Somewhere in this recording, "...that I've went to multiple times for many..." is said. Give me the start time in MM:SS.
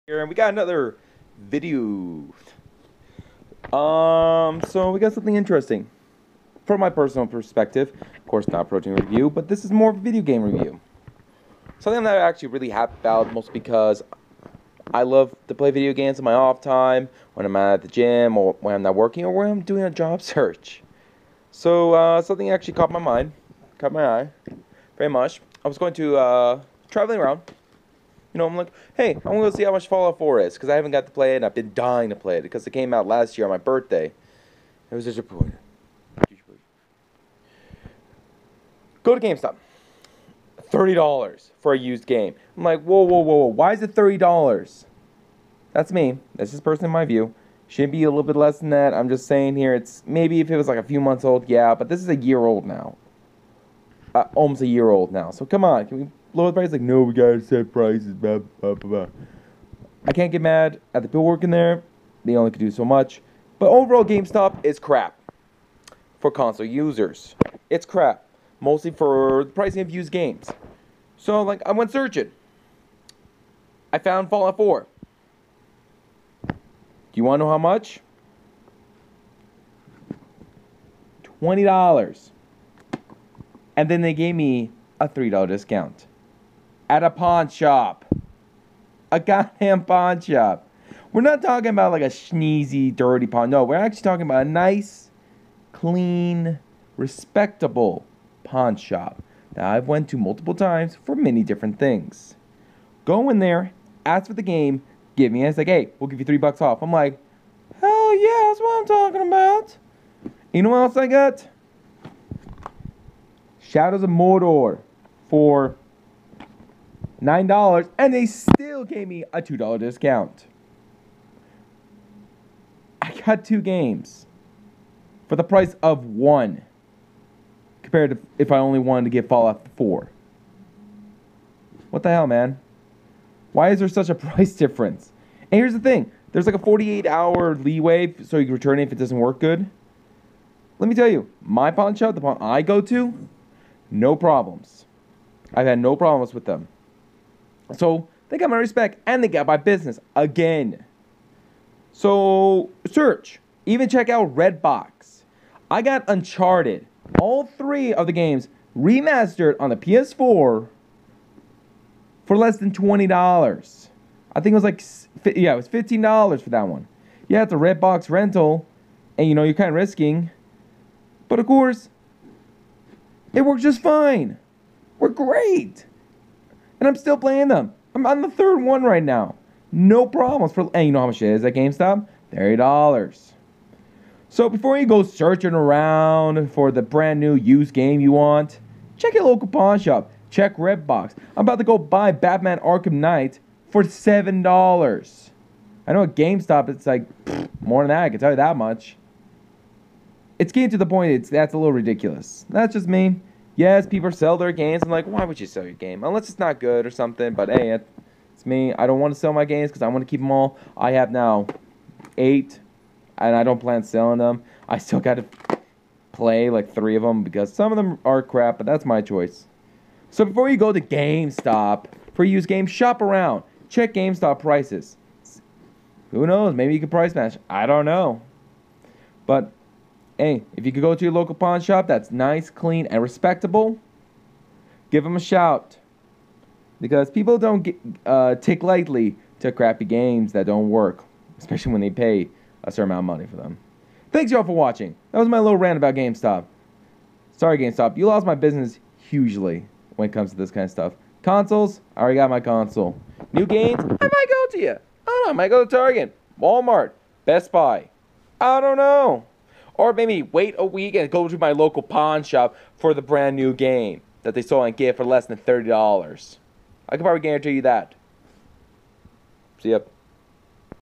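01:39.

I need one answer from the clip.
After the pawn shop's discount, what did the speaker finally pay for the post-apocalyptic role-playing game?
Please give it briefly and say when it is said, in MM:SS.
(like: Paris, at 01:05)
$20, at 01:21.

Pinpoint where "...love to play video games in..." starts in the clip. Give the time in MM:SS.
00:15.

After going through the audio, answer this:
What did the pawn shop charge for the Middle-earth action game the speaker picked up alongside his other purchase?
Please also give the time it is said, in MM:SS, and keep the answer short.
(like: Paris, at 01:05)
$9, at 01:57.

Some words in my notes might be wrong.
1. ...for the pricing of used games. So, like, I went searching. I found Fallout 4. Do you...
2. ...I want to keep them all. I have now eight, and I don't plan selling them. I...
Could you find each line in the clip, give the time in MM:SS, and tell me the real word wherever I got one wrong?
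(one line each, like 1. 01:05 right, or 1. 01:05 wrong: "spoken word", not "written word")
1. 01:08 right
2. 03:29 right.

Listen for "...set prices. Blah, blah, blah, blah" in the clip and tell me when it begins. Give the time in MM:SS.
00:57.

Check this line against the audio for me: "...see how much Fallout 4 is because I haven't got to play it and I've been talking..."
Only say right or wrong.
wrong.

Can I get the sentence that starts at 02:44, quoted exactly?
I think it was like yeah, it was fifteen dollars for that one.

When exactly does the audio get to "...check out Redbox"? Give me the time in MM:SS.
02:33.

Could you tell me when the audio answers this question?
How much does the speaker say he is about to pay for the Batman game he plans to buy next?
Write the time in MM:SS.
03:13.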